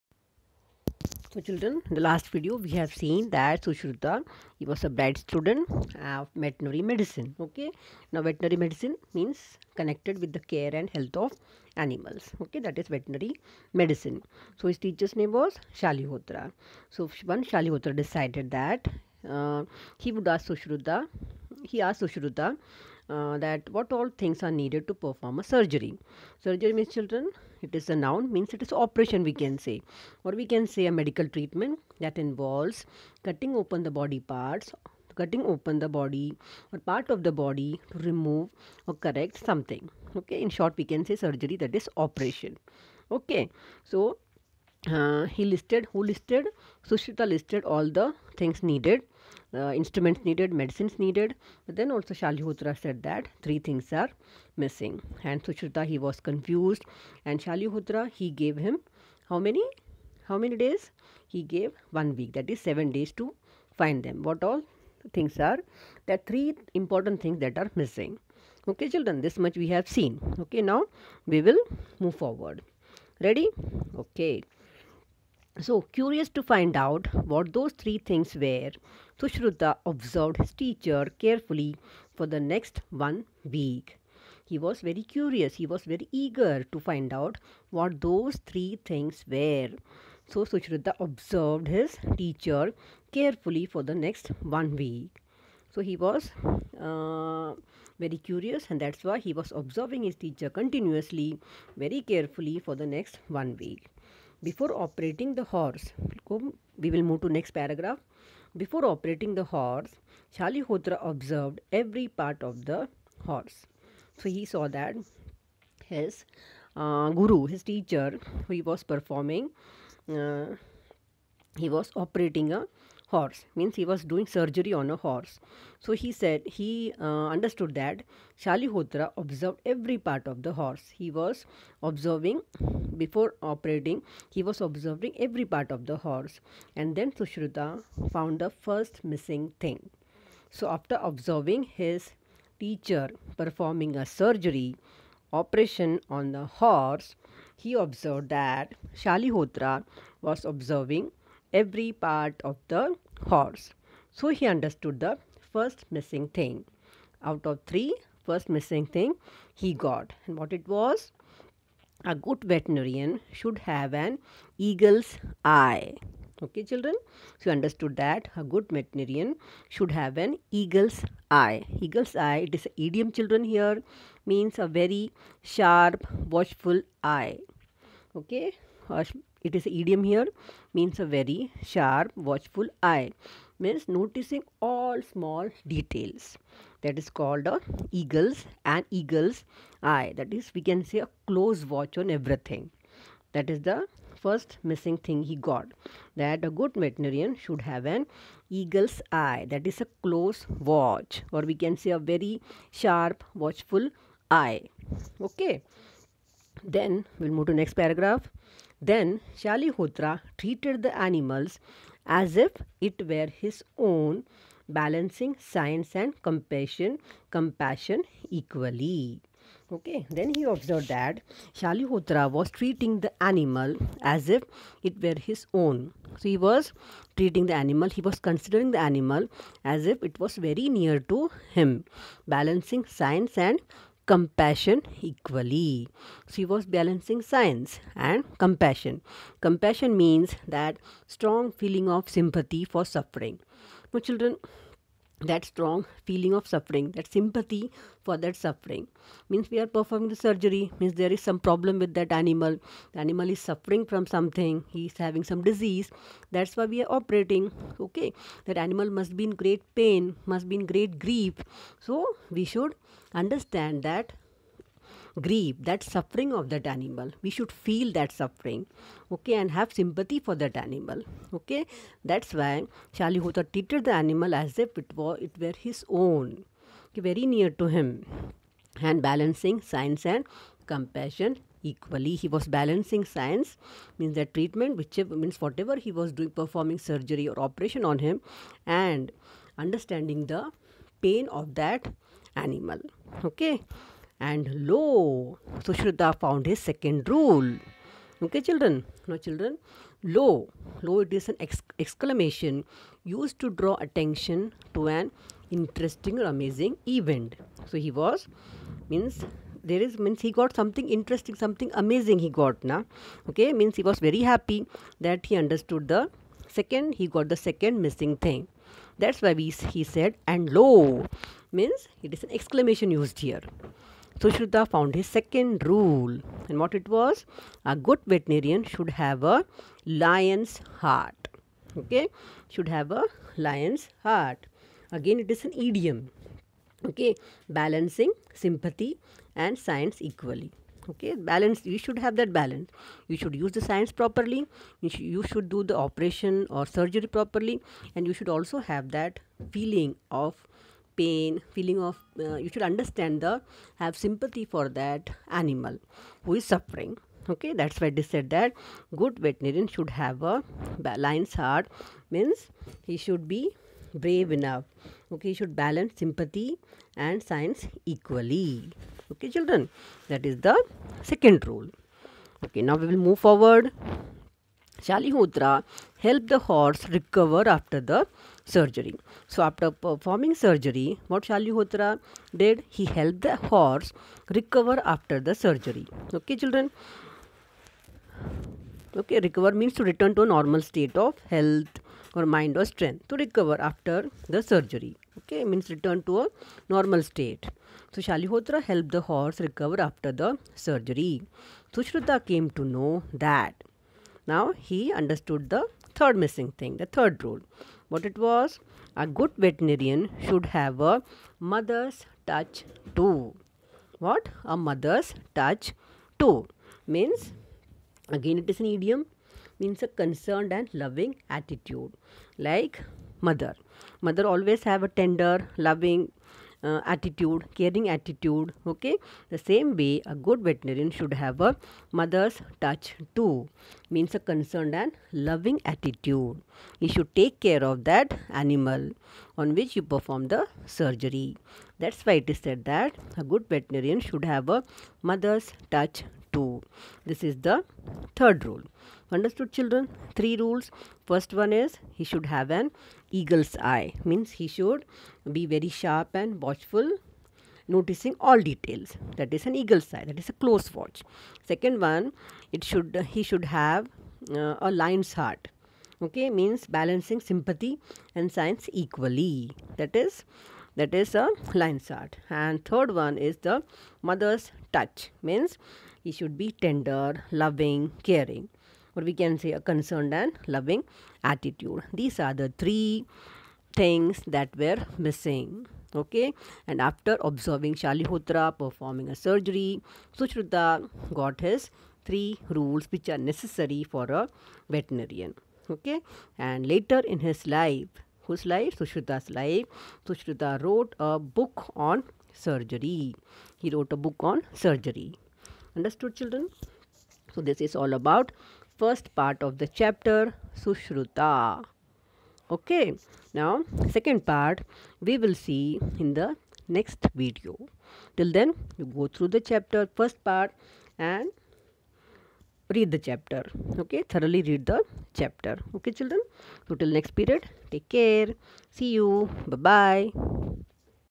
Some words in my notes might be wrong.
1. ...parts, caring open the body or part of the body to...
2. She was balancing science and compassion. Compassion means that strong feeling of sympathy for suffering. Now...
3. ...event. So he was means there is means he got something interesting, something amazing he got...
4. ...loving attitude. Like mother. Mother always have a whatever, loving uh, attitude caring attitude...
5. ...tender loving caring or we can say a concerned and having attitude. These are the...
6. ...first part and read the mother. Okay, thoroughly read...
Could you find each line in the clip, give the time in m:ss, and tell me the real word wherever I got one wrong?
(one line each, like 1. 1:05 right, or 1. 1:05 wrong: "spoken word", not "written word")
1. 0:34 wrong: "cutting", not "caring"
2. 3:56 right
3. 5:06 right
4. 7:00 wrong: "tender", not "whatever"
5. 7:56 wrong: "loving", not "having"
6. 8:40 wrong: "chapter", not "mother".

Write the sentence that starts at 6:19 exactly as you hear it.
So after performing surgery, what Shalihotra did?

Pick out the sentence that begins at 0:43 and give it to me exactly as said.
Okay, so uh, he listed, who listed?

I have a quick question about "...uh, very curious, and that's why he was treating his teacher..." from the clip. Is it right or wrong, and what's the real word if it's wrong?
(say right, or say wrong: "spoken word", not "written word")
wrong: "observing", not "treating".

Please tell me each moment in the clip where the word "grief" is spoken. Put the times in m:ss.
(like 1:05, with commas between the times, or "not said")
4:20, 4:25.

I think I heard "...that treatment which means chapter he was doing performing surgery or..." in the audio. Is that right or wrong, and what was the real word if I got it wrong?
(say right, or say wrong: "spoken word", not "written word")
wrong: "whatever", not "chapter".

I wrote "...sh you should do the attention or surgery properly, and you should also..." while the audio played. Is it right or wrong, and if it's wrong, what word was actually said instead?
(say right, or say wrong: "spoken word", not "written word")
wrong: "operation", not "attention".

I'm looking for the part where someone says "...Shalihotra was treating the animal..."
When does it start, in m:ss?
3:41.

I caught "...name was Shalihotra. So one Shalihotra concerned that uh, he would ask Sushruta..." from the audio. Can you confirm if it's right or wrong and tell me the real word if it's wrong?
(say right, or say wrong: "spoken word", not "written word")
wrong: "decided", not "concerned".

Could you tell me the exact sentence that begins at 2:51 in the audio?
Eagle's eye, it is an idiom, children, here means a very sharp, watchful eye.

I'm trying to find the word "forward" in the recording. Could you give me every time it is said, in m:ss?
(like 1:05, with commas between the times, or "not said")
1:12, 6:13.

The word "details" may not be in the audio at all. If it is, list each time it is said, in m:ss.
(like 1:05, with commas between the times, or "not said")
3:05, 7:38.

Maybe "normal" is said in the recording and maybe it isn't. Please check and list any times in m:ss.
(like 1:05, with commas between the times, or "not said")
6:30, 6:36.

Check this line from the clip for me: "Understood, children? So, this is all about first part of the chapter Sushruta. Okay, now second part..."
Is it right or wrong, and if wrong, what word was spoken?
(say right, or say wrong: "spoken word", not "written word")
right.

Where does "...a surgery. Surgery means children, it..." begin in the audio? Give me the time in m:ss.
0:25.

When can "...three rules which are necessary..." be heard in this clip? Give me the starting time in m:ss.
8:12.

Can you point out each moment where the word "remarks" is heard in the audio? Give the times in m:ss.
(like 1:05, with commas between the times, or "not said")
not said.